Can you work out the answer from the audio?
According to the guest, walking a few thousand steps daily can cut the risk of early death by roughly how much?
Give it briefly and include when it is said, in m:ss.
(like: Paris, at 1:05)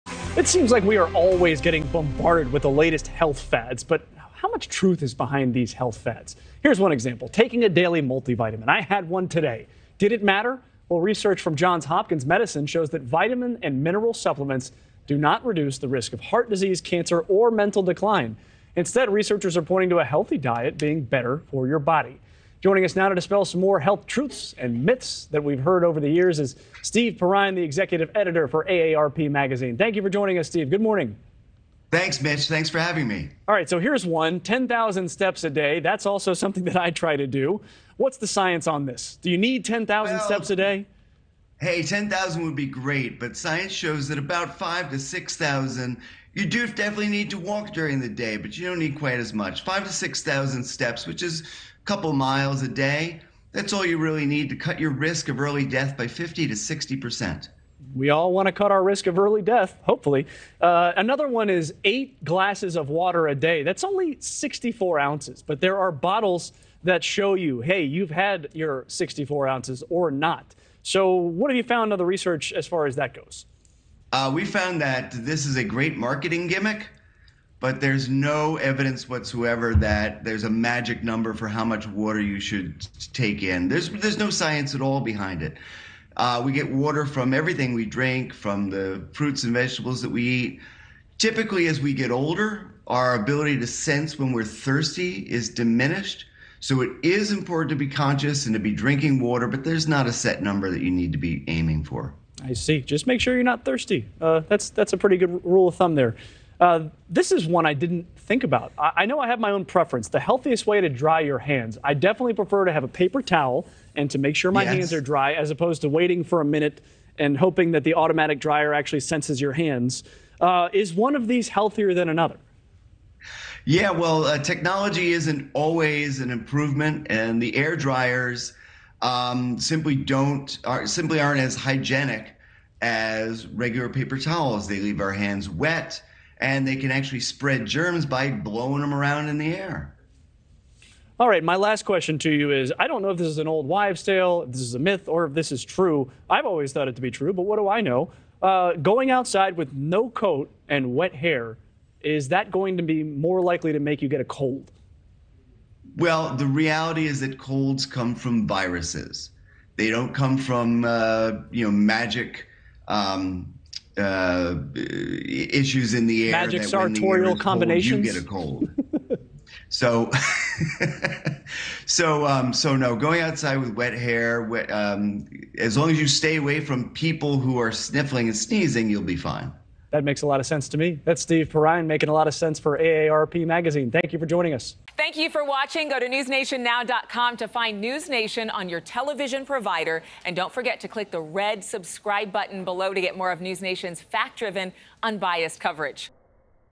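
50 to 60 percent, at 0:56.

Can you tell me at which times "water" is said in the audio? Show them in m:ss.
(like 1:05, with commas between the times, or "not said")
1:02, 1:21, 1:26, 1:39.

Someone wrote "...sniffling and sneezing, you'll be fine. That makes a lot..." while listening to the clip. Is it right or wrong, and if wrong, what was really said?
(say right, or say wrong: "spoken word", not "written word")
right.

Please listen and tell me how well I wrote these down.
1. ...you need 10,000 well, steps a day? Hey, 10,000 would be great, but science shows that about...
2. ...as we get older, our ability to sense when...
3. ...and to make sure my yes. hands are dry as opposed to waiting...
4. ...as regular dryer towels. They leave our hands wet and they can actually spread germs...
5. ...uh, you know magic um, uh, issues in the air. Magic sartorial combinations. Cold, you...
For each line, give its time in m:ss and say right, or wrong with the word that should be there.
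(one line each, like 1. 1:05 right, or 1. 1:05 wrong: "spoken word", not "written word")
1. 0:39 right
2. 1:31 right
3. 1:53 right
4. 2:12 wrong: "paper", not "dryer"
5. 2:40 right.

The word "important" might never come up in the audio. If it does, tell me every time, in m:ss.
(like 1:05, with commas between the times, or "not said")
1:37.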